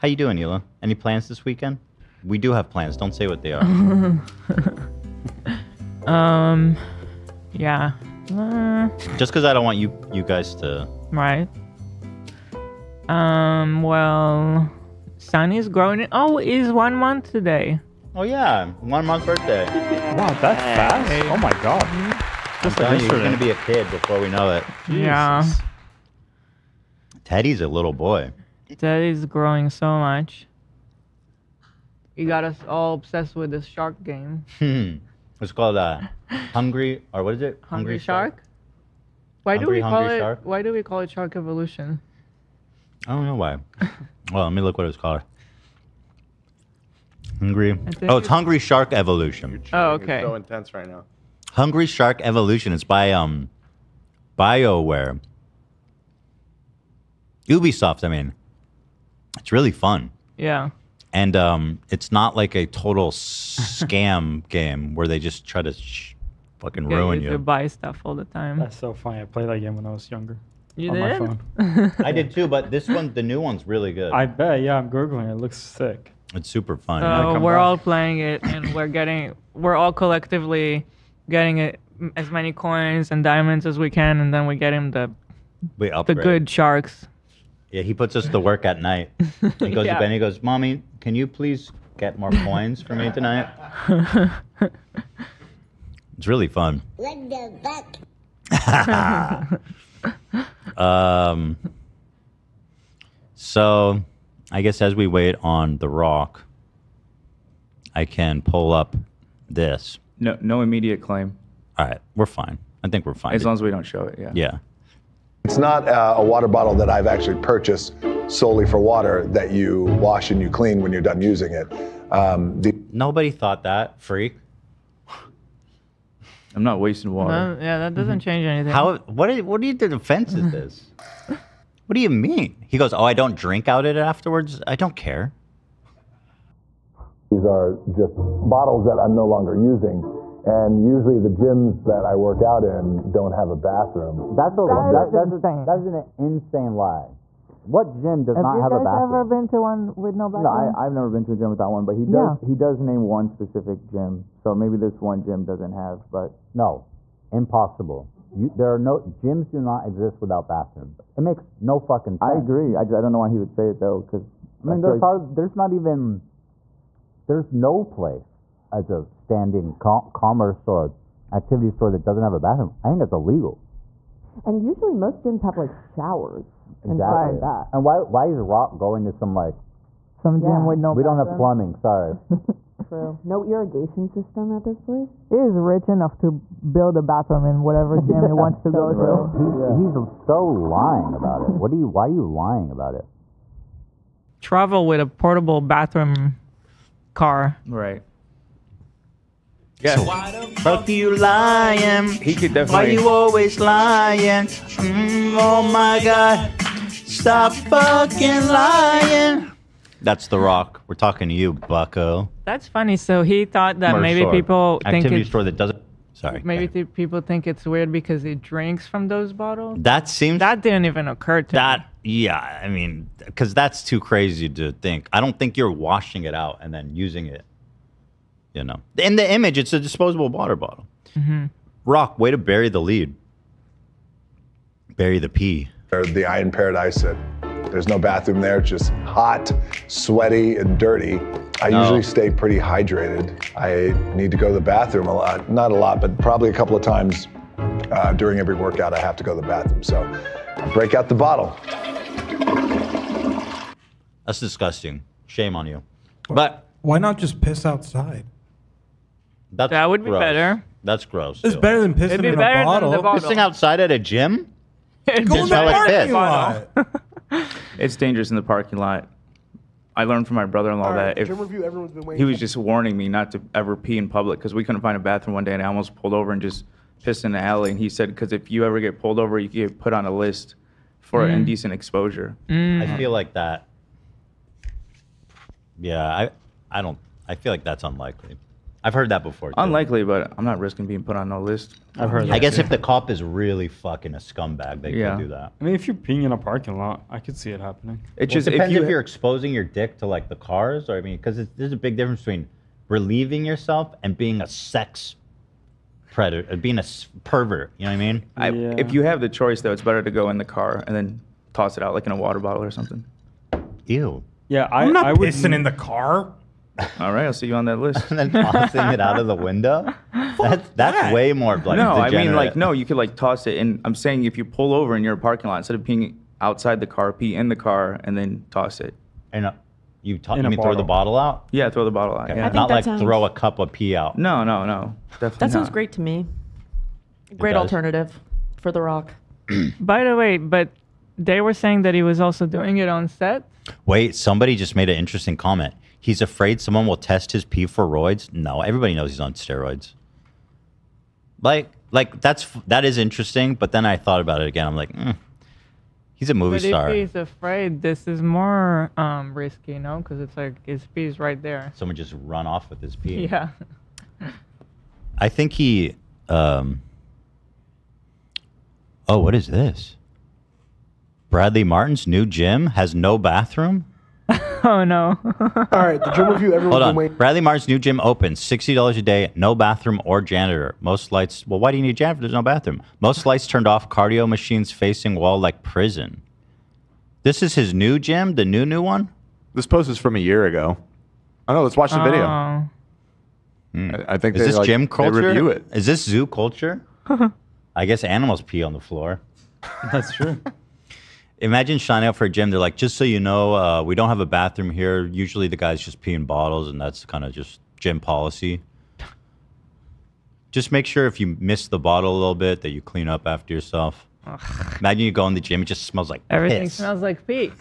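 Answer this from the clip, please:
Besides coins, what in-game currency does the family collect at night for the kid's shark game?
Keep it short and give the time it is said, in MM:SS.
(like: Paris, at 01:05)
Diamonds, at 01:23.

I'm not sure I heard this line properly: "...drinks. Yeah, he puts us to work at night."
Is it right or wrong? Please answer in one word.
wrong.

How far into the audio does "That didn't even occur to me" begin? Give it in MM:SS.
03:40.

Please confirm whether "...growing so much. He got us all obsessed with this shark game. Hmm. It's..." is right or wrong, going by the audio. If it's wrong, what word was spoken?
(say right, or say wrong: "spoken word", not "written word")
right.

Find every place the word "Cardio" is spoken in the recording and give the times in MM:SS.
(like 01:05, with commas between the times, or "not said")
06:23.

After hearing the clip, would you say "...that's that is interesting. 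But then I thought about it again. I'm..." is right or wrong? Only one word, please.
right.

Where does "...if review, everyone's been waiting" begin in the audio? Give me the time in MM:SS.
04:31.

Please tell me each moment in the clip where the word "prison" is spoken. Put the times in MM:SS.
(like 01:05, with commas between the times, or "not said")
06:25.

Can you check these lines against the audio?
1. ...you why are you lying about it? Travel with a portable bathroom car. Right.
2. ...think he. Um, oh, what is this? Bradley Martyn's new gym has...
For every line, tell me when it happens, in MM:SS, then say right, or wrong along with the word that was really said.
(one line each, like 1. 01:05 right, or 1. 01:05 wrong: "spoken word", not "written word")
1. 03:11 right
2. 06:05 right.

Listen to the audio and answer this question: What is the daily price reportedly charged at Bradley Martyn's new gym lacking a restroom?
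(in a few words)
$60.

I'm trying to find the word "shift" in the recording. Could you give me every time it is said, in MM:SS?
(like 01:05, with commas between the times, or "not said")
not said.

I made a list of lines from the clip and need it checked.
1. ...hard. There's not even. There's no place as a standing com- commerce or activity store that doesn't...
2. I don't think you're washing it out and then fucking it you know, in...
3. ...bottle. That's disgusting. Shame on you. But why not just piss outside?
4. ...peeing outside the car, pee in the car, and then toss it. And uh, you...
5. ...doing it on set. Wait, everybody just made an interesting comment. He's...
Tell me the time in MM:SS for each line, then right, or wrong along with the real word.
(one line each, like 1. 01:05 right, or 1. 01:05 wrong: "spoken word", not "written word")
1. 02:45 right
2. 03:45 wrong: "using", not "fucking"
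3. 04:11 right
4. 05:25 right
5. 05:42 wrong: "somebody", not "everybody".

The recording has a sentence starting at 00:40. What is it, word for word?
Why do we call it Shark Evolution?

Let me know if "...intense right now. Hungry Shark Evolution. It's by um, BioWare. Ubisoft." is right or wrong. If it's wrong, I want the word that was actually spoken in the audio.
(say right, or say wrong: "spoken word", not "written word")
right.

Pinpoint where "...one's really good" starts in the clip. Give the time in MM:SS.
01:13.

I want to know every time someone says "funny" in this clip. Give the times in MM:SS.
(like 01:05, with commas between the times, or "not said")
01:08, 03:32.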